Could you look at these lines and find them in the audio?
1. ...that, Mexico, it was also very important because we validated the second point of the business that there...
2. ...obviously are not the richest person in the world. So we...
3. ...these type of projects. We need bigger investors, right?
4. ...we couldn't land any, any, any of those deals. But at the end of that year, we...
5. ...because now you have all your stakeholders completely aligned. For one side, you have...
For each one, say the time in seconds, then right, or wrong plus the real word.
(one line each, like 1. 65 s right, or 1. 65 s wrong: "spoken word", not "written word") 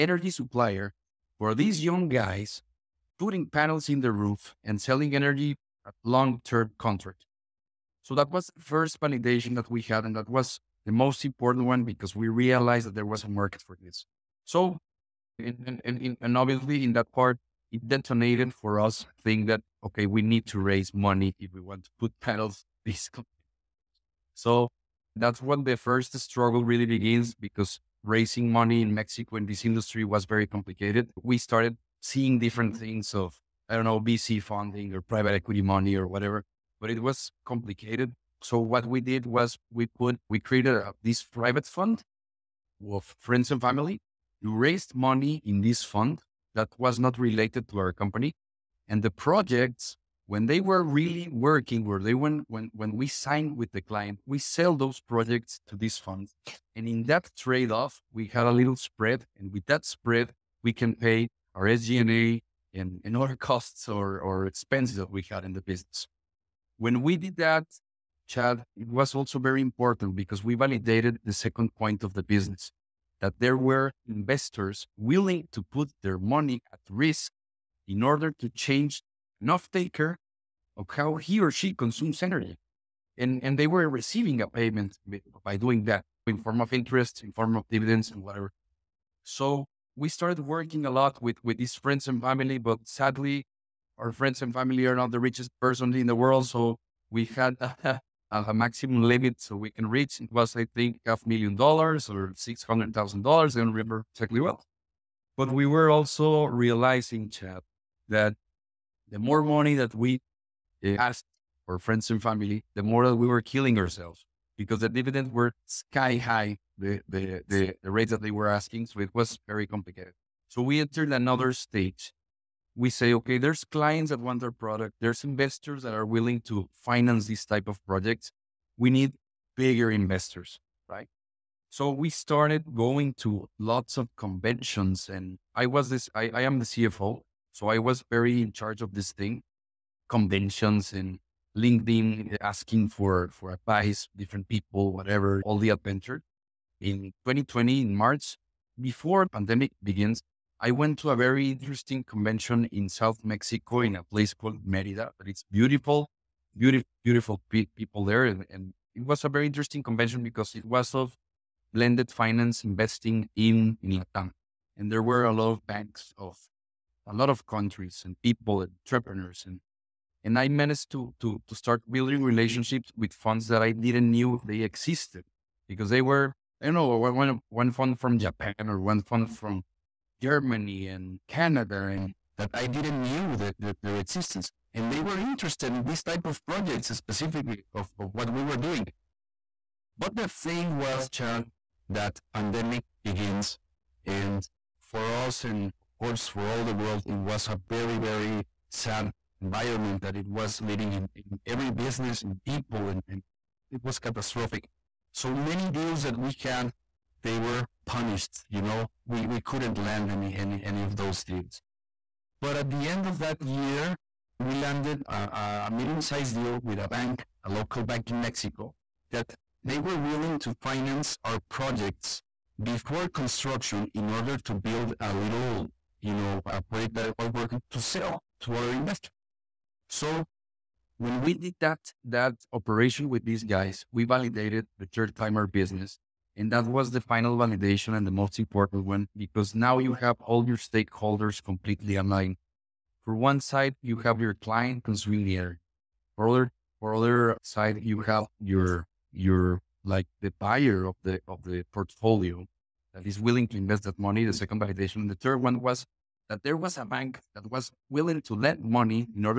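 1. 67 s wrong: "Chad", not "Mexico"
2. 94 s wrong: "family", not "obviously"
3. 127 s right
4. 209 s right
5. 239 s right.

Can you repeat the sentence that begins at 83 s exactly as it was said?
And, and they were receiving a payment by doing that in form of interest, in form of dividends and whatever.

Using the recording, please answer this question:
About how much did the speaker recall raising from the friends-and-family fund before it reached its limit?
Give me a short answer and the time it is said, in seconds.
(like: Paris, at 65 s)
$500,000, at 101 s.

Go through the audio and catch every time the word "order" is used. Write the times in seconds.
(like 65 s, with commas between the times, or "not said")
78 s, 224 s.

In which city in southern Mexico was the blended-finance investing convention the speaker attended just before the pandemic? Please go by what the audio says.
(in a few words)
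Merida.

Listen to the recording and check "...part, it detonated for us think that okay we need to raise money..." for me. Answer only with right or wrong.
right.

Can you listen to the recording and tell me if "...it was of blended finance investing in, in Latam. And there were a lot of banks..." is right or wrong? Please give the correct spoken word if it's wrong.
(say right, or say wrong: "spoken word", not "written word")
right.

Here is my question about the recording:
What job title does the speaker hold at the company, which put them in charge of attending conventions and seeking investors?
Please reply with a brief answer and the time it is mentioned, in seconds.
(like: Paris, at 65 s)
CFO, at 136 s.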